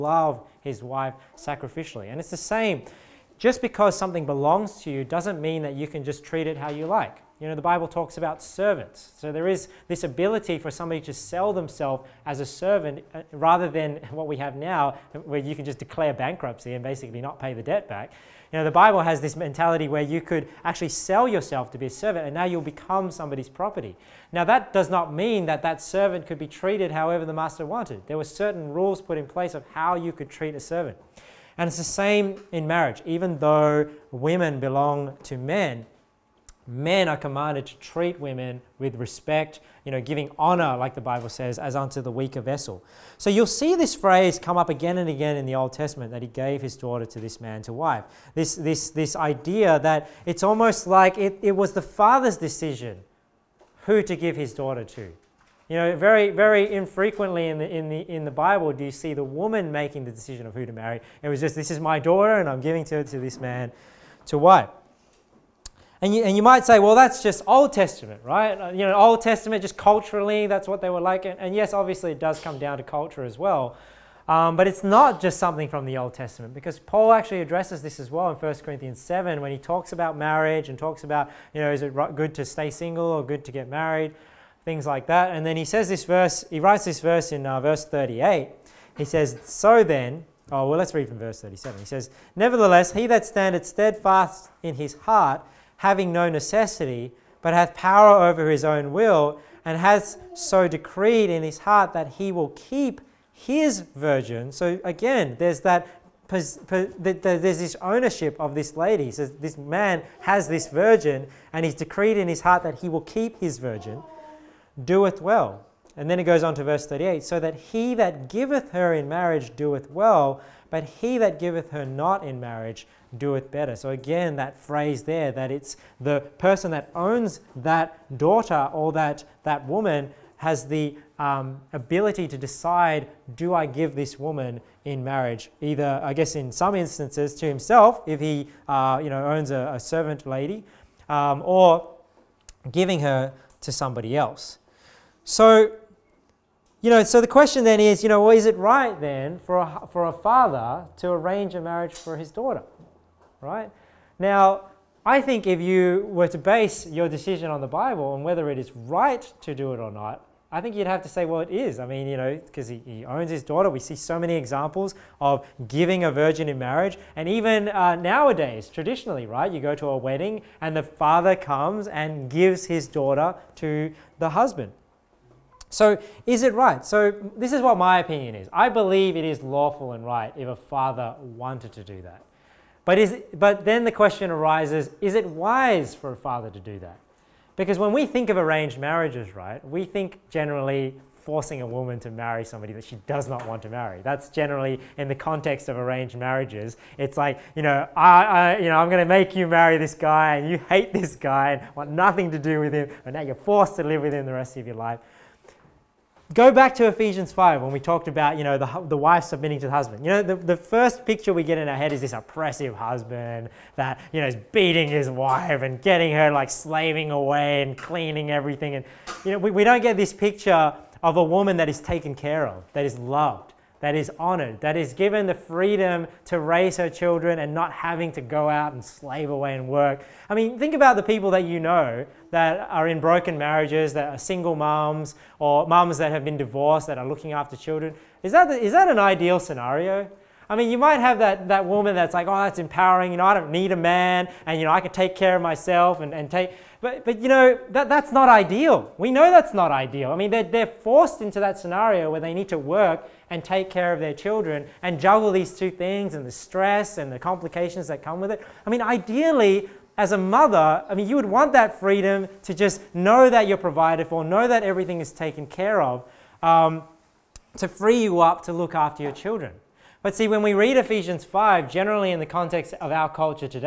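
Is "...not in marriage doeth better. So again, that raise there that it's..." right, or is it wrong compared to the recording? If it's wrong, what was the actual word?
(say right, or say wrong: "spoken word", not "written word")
wrong: "phrase", not "raise".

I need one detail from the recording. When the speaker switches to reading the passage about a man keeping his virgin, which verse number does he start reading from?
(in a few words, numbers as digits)
37.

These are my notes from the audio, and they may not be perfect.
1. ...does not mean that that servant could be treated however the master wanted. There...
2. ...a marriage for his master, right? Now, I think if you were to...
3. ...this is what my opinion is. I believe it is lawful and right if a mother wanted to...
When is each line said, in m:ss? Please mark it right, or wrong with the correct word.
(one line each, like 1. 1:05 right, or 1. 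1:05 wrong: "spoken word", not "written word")
1. 0:24 right
2. 2:31 wrong: "daughter", not "master"
3. 2:57 wrong: "father", not "mother".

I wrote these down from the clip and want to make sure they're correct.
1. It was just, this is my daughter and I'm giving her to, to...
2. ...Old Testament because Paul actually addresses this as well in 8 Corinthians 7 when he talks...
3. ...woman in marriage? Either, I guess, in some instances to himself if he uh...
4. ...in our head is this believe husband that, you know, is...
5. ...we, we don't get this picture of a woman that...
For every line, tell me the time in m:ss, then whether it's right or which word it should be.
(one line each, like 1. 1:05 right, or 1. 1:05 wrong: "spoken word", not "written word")
1. 1:01 right
2. 1:15 wrong: "1", not "8"
3. 2:14 right
4. 3:31 wrong: "oppressive", not "believe"
5. 3:39 right.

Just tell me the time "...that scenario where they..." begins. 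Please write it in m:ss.
4:11.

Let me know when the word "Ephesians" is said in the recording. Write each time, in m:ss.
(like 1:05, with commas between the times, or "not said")
3:26, 4:30.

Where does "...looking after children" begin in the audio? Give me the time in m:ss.
3:57.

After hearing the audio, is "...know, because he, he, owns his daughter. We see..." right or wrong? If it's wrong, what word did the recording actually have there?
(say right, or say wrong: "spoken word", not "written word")
right.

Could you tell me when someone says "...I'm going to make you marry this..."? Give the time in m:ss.
3:18.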